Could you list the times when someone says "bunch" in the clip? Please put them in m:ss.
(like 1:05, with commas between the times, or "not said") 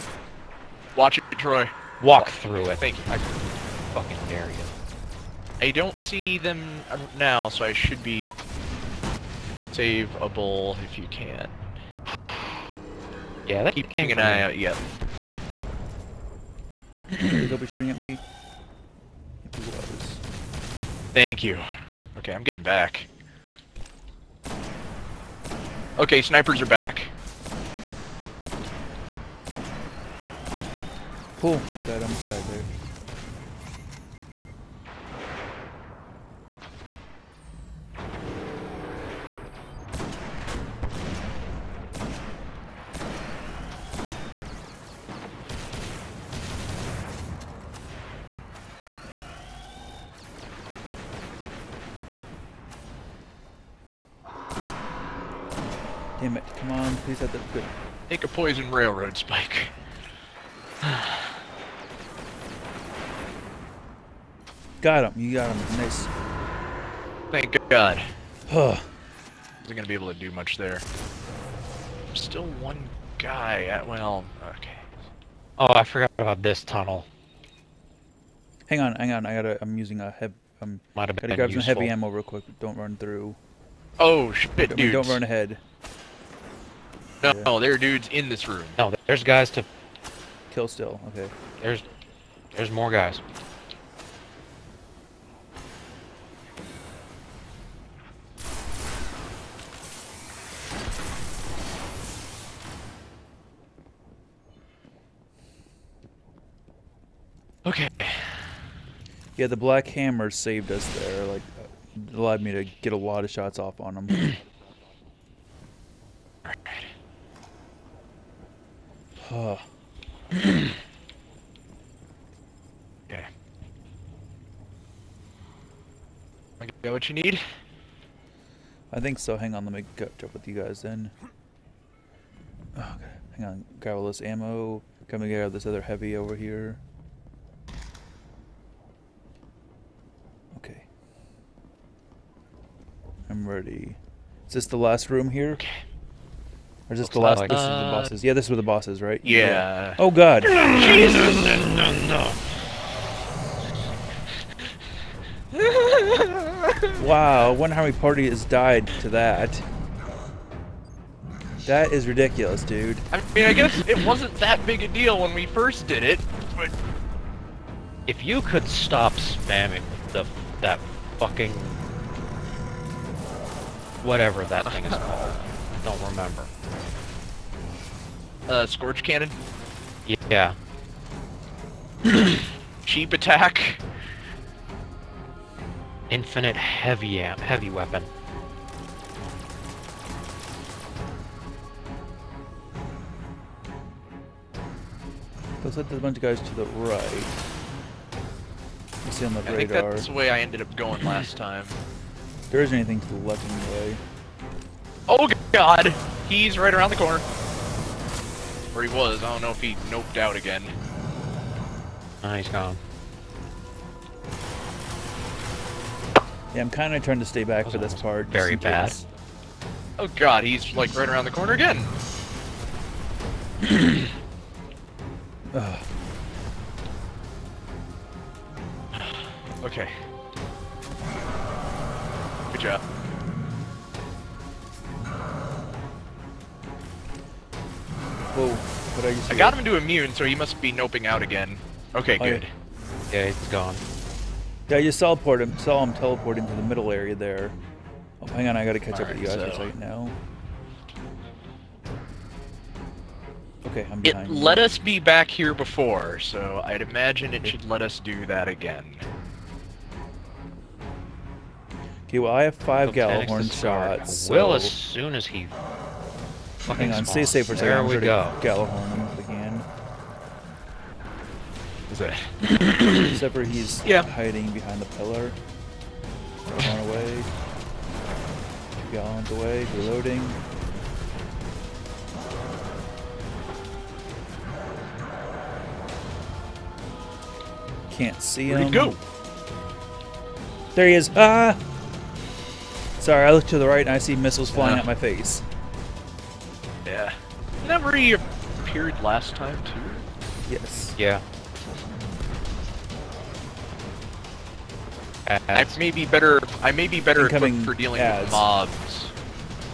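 3:16.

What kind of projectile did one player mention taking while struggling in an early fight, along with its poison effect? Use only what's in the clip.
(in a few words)
Railroad spike.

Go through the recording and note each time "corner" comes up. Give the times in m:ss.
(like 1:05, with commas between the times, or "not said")
3:26, 3:41.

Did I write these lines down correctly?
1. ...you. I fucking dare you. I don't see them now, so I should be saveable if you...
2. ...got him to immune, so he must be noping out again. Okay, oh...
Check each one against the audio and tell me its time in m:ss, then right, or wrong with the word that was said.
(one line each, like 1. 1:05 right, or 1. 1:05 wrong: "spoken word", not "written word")
1. 0:02 right
2. 3:59 right.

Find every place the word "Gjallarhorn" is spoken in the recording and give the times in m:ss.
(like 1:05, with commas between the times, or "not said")
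4:22, 4:28.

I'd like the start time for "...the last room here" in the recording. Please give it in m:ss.
2:24.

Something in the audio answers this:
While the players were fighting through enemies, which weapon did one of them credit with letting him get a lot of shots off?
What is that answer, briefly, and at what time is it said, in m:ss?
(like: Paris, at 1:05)
Black Hammer, at 1:49.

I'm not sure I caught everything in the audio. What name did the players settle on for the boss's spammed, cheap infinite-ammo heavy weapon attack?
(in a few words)
Scorch Cannon.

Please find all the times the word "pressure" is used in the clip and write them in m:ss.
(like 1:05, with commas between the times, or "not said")
not said.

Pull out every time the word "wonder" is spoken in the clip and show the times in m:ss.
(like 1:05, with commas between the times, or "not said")
2:37.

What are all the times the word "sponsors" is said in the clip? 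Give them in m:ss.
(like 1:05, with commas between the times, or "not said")
not said.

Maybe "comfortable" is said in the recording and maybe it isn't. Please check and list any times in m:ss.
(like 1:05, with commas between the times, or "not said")
not said.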